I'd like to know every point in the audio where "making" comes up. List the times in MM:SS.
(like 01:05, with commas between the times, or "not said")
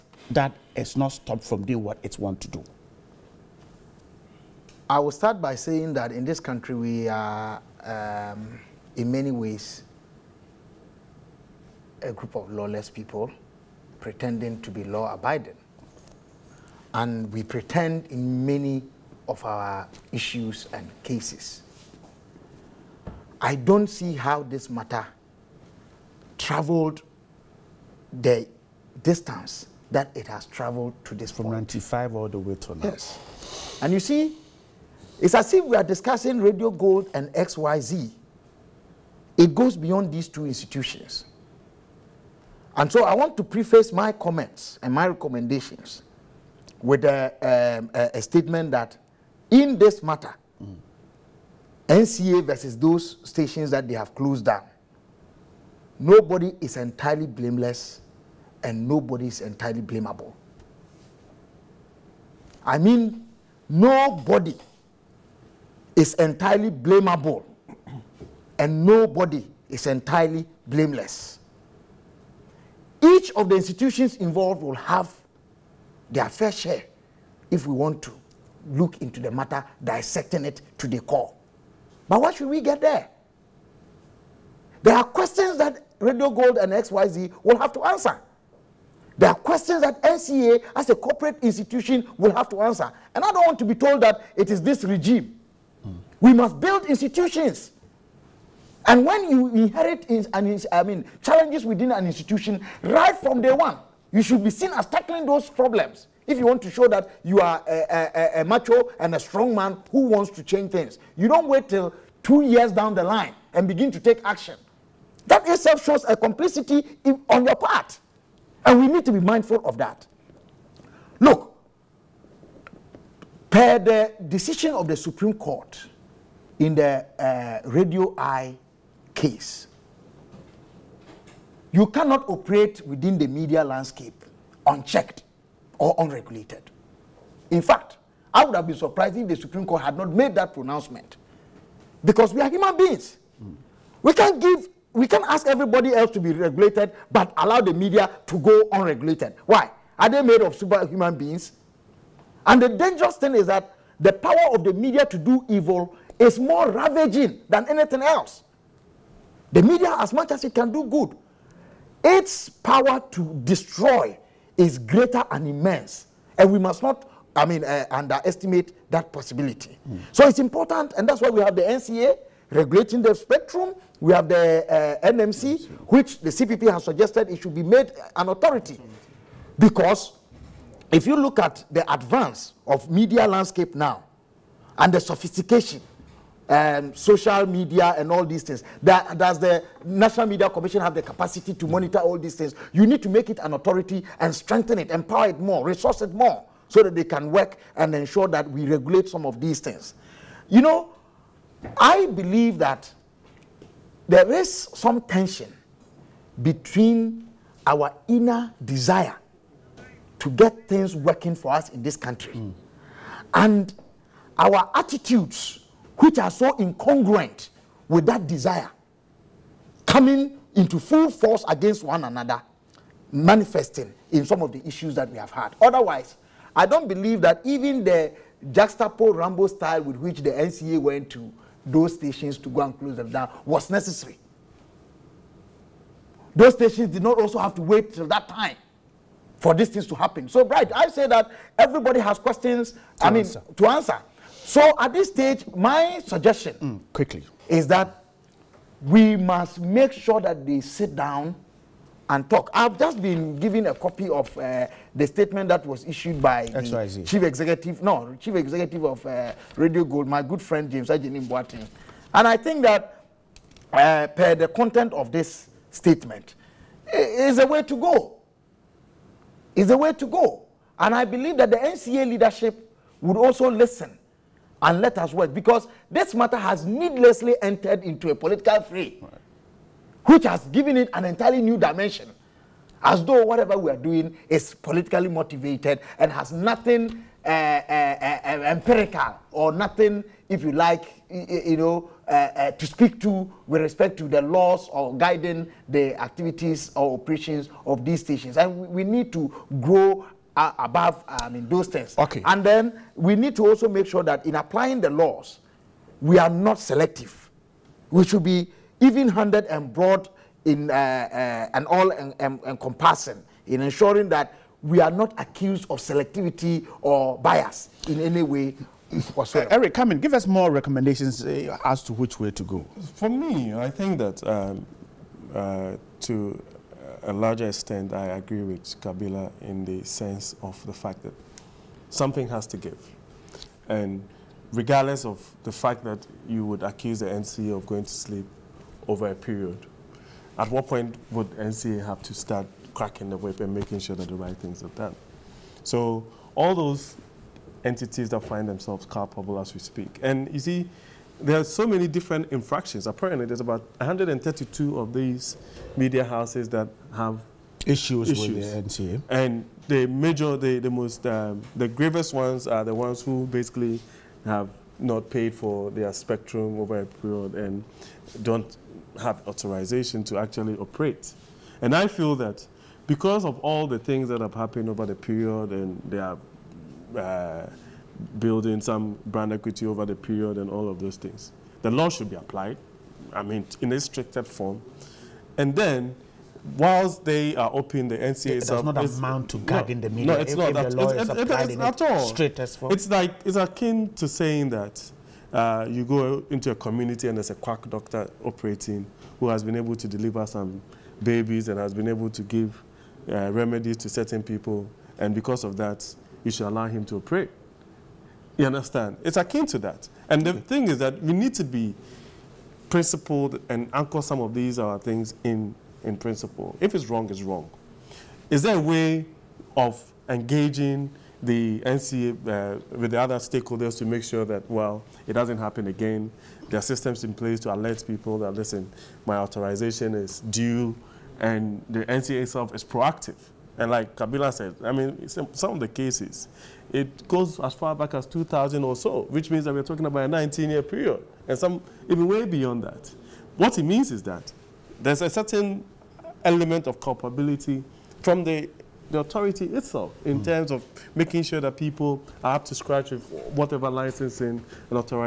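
05:43, 07:30.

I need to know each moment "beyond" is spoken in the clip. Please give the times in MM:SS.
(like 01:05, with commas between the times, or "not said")
00:39, 07:22.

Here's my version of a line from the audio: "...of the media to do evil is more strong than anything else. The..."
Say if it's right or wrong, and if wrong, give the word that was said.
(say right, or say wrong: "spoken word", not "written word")
wrong: "ravaging", not "strong".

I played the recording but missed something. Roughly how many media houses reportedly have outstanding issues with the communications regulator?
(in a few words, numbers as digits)
132.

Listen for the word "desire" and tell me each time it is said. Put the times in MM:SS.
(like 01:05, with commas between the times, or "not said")
03:28, 03:38.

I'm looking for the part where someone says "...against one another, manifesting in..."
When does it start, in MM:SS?
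03:41.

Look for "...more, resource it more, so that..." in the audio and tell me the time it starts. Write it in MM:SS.
03:15.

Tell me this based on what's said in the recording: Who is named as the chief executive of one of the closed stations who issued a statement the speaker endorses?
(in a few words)
James Ajini Boateng.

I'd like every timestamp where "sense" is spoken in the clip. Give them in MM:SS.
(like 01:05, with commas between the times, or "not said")
05:29.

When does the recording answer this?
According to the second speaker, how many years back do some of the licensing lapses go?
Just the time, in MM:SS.
07:20.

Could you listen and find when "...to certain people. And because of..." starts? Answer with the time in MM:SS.
06:43.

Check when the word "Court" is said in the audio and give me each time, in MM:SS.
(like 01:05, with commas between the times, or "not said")
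02:05, 02:19.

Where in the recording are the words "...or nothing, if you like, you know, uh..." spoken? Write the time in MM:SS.
04:49.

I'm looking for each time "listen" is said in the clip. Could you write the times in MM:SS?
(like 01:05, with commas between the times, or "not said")
04:33, 07:08.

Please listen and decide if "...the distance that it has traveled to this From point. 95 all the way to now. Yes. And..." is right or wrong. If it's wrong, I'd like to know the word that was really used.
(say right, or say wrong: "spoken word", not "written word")
right.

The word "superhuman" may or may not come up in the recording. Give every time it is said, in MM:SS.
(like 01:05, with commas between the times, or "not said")
02:30.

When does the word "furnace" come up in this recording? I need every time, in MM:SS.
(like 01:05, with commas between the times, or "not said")
not said.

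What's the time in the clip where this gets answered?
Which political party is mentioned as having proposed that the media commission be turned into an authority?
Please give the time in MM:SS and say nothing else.
02:56.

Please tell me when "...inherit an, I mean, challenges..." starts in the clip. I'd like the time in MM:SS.
01:39.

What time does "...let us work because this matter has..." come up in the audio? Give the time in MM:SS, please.
04:34.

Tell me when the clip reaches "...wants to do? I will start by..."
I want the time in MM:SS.
00:02.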